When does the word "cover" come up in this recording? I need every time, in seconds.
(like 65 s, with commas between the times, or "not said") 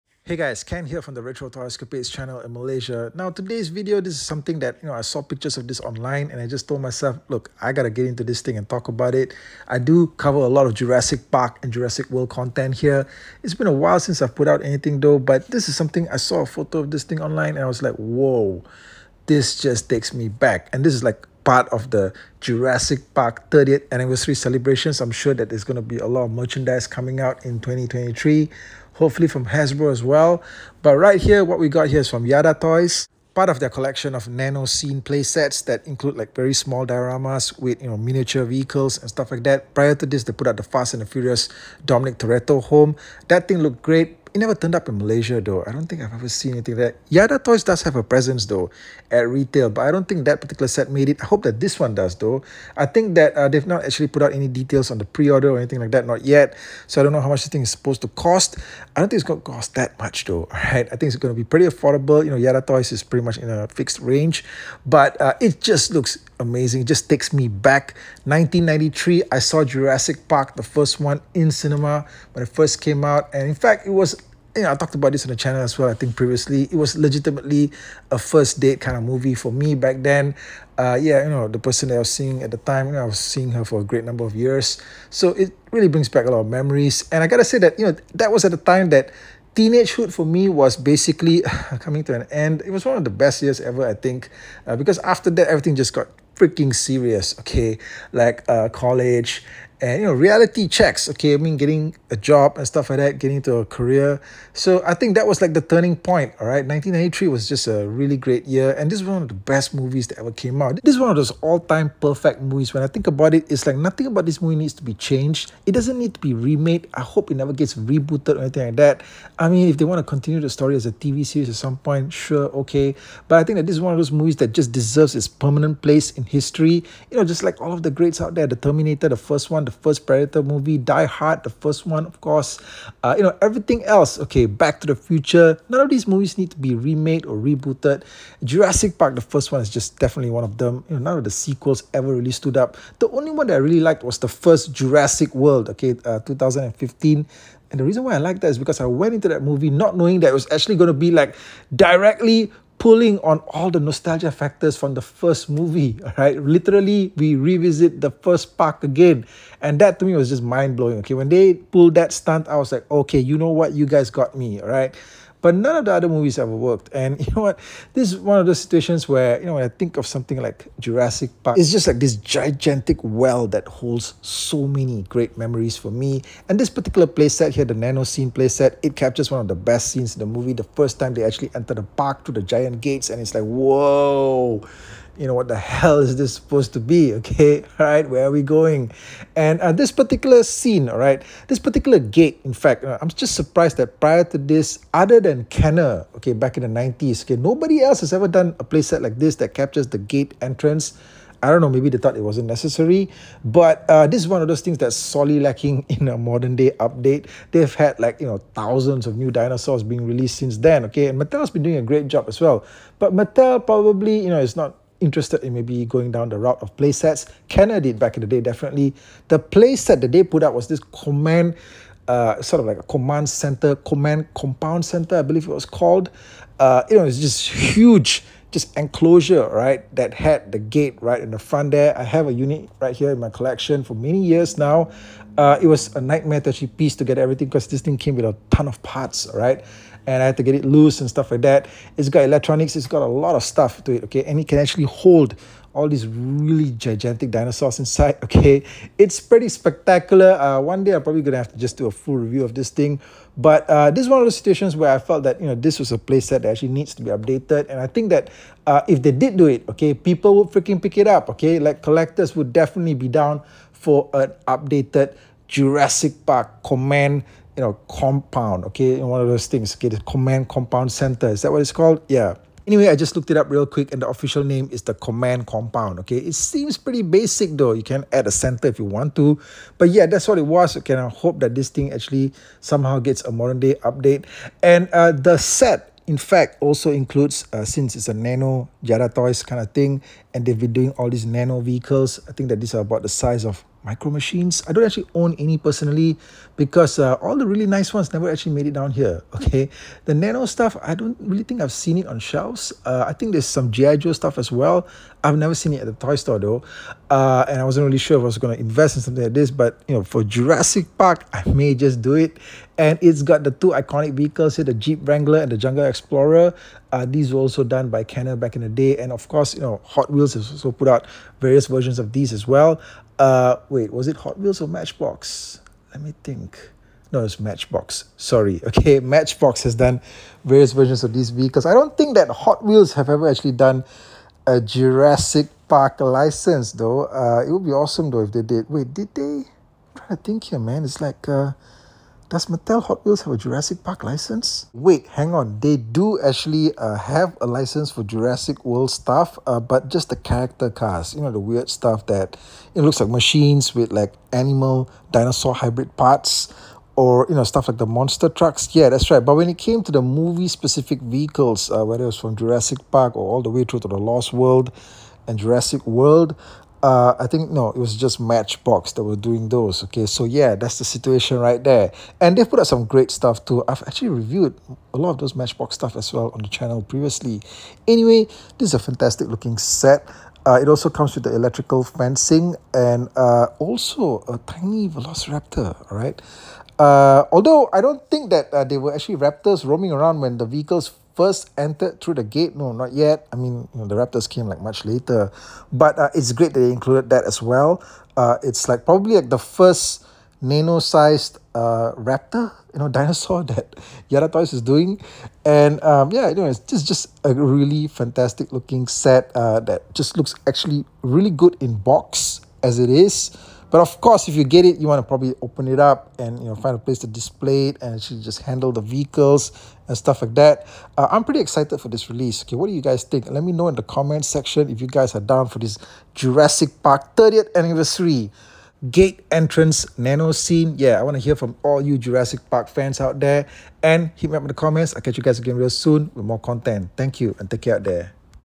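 10 s.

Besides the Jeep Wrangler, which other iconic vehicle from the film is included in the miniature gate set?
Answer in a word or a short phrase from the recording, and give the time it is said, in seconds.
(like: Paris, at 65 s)
Jungle Explorer, at 315 s.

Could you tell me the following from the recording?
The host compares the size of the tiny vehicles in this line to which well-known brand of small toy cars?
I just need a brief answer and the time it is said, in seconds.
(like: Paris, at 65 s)
Micro Machines, at 293 s.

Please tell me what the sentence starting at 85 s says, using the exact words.
So it really brings back a lot of memories.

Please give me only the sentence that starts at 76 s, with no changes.
It was legitimately a first date kind of movie for me back then.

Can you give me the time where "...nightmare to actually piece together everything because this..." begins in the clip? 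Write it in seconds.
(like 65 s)
236 s.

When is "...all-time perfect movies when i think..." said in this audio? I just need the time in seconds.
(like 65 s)
111 s.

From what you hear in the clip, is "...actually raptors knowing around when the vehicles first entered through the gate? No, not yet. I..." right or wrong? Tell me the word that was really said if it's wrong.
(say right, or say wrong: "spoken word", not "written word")
wrong: "roaming", not "knowing".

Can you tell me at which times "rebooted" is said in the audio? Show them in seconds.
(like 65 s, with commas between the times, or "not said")
117 s, 137 s.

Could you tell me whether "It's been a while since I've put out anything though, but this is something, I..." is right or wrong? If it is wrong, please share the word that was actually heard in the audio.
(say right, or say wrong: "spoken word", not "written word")
right.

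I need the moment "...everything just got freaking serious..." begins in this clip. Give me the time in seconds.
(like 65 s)
95 s.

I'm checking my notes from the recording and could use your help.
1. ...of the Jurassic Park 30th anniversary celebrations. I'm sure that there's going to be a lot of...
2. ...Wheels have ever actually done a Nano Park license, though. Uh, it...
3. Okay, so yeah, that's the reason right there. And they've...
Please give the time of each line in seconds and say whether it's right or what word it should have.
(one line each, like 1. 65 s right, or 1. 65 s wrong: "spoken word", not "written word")
1. 21 s right
2. 332 s wrong: "Jurassic", not "Nano"
3. 369 s wrong: "situation", not "reason".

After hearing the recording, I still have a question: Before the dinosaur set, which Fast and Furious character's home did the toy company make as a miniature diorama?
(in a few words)
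Dominic Toretto.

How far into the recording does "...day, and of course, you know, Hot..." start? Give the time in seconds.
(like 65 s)
318 s.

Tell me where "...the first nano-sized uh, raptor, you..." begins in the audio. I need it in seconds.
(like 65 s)
399 s.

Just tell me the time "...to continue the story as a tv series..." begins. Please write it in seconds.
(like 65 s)
119 s.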